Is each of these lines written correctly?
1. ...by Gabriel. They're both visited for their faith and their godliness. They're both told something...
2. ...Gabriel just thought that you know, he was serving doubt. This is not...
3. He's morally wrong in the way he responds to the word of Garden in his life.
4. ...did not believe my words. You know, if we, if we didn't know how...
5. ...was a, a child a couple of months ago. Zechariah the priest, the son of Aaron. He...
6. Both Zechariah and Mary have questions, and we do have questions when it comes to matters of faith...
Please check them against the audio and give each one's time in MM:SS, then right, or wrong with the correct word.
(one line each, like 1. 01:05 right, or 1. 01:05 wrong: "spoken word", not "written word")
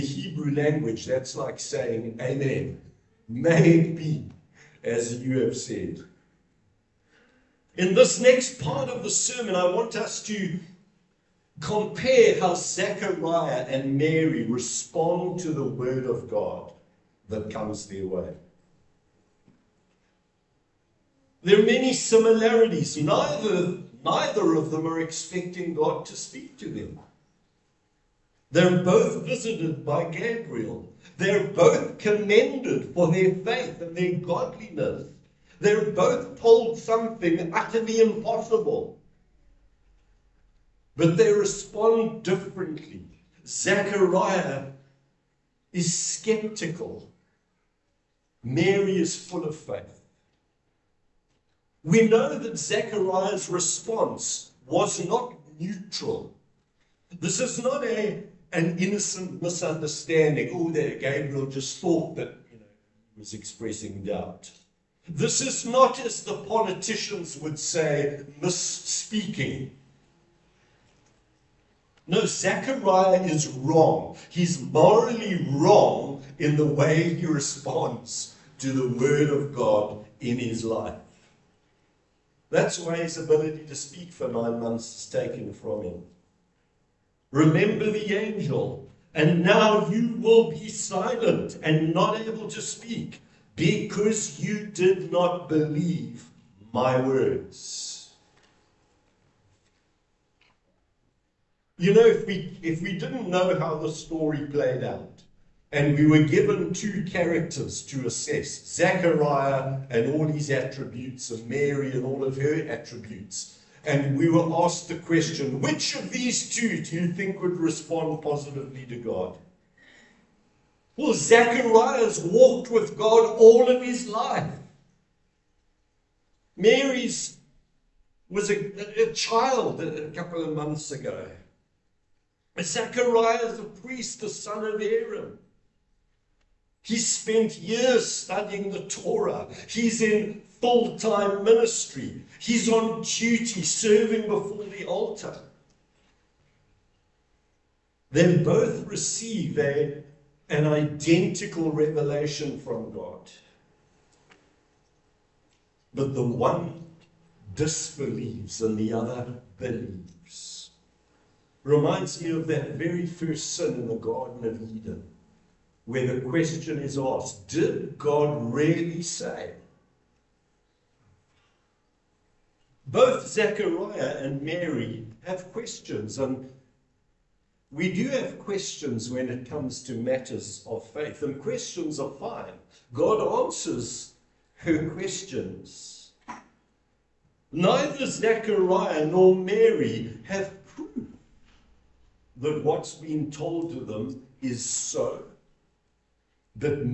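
1. 00:29 wrong: "commended", not "visited"
2. 01:00 wrong: "expressing", not "serving"
3. 01:14 wrong: "God", not "Garden"
4. 01:34 right
5. 02:08 right
6. 02:52 right.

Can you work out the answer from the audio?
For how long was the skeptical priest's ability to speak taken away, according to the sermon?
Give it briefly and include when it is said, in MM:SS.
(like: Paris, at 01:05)
9 months, at 01:24.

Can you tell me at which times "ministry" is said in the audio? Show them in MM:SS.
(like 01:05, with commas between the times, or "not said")
02:21.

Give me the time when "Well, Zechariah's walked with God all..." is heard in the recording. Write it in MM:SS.
02:00.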